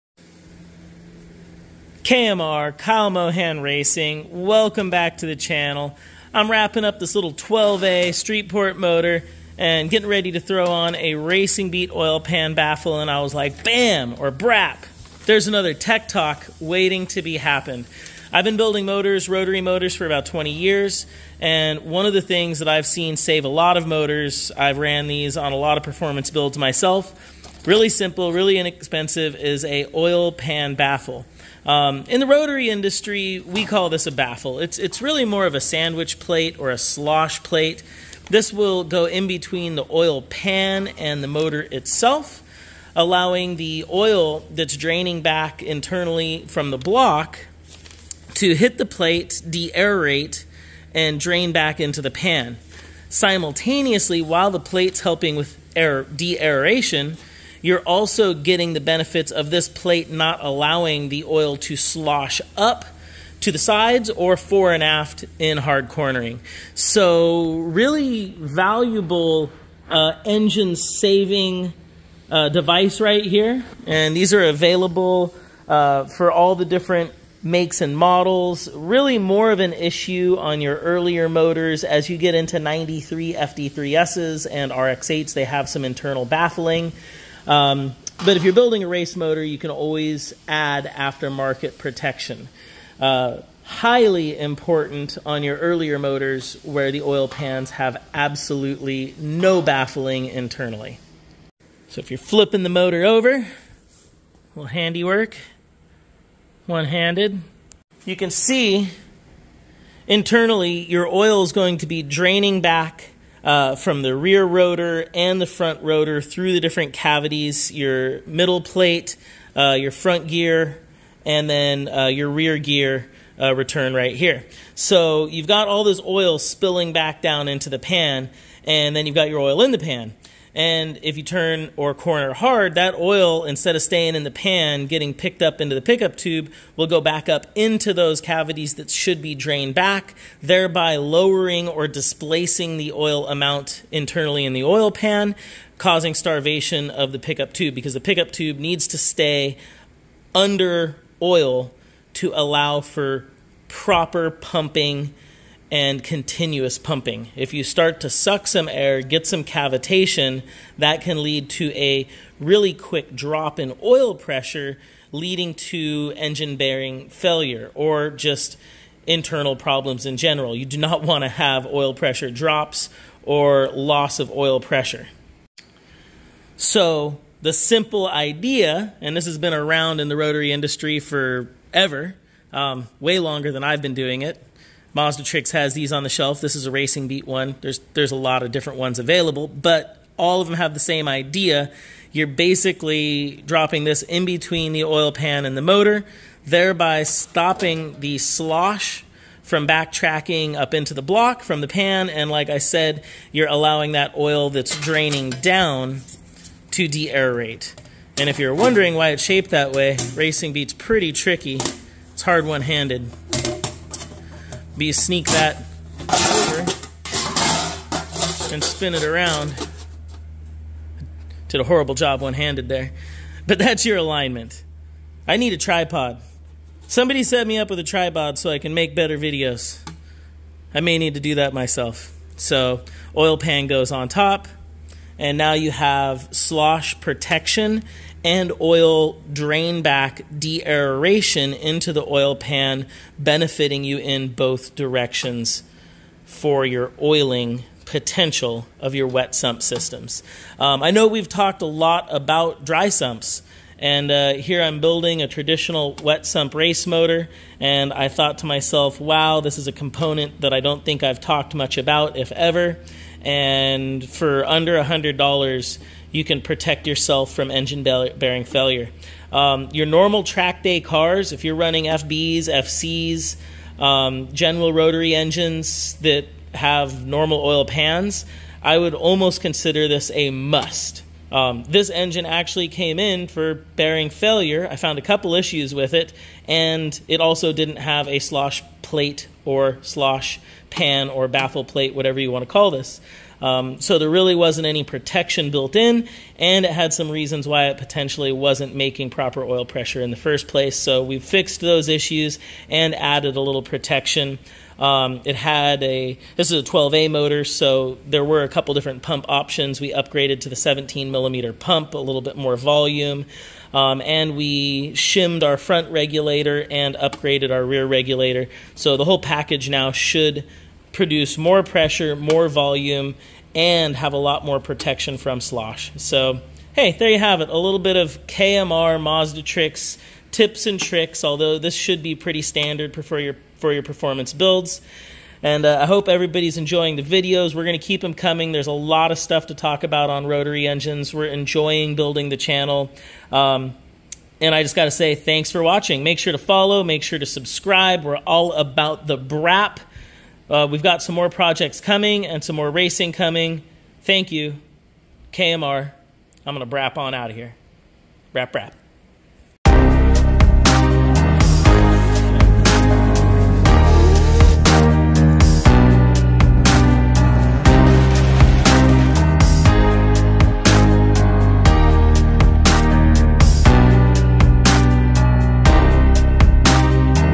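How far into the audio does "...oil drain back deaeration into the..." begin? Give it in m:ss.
3:58.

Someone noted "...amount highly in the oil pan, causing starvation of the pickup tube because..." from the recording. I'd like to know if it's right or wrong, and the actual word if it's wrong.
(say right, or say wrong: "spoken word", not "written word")
wrong: "internally", not "highly".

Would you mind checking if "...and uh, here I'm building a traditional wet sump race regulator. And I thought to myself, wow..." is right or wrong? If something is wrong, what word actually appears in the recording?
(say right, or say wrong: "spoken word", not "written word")
wrong: "motor", not "regulator".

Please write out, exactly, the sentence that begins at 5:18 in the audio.
So the whole package now should produce more pressure, more volume, and have a lot more protection from slosh.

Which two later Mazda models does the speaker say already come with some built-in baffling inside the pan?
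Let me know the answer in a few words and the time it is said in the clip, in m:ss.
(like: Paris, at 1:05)
FD3Ss and RX8s, at 1:23.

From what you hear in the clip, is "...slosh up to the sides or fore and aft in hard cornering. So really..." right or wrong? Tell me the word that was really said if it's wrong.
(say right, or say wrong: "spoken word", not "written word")
right.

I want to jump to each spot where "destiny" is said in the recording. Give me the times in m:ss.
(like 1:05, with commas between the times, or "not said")
not said.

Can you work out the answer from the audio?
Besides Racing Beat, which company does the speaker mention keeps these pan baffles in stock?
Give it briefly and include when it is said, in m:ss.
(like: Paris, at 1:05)
Mazdatrix, at 3:04.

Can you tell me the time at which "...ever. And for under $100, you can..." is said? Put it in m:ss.
4:22.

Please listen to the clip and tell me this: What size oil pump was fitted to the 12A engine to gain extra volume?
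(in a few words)
17 millimeter.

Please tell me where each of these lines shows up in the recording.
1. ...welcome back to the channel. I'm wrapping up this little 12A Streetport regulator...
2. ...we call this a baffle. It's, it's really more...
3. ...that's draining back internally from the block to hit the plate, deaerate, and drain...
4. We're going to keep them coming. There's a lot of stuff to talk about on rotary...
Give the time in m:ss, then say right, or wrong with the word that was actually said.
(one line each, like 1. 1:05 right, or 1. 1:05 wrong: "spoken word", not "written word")
1. 0:04 wrong: "motor", not "regulator"
2. 0:33 right
3. 0:44 right
4. 5:37 right.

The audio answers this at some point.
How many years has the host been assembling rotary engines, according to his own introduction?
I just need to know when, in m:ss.
0:20.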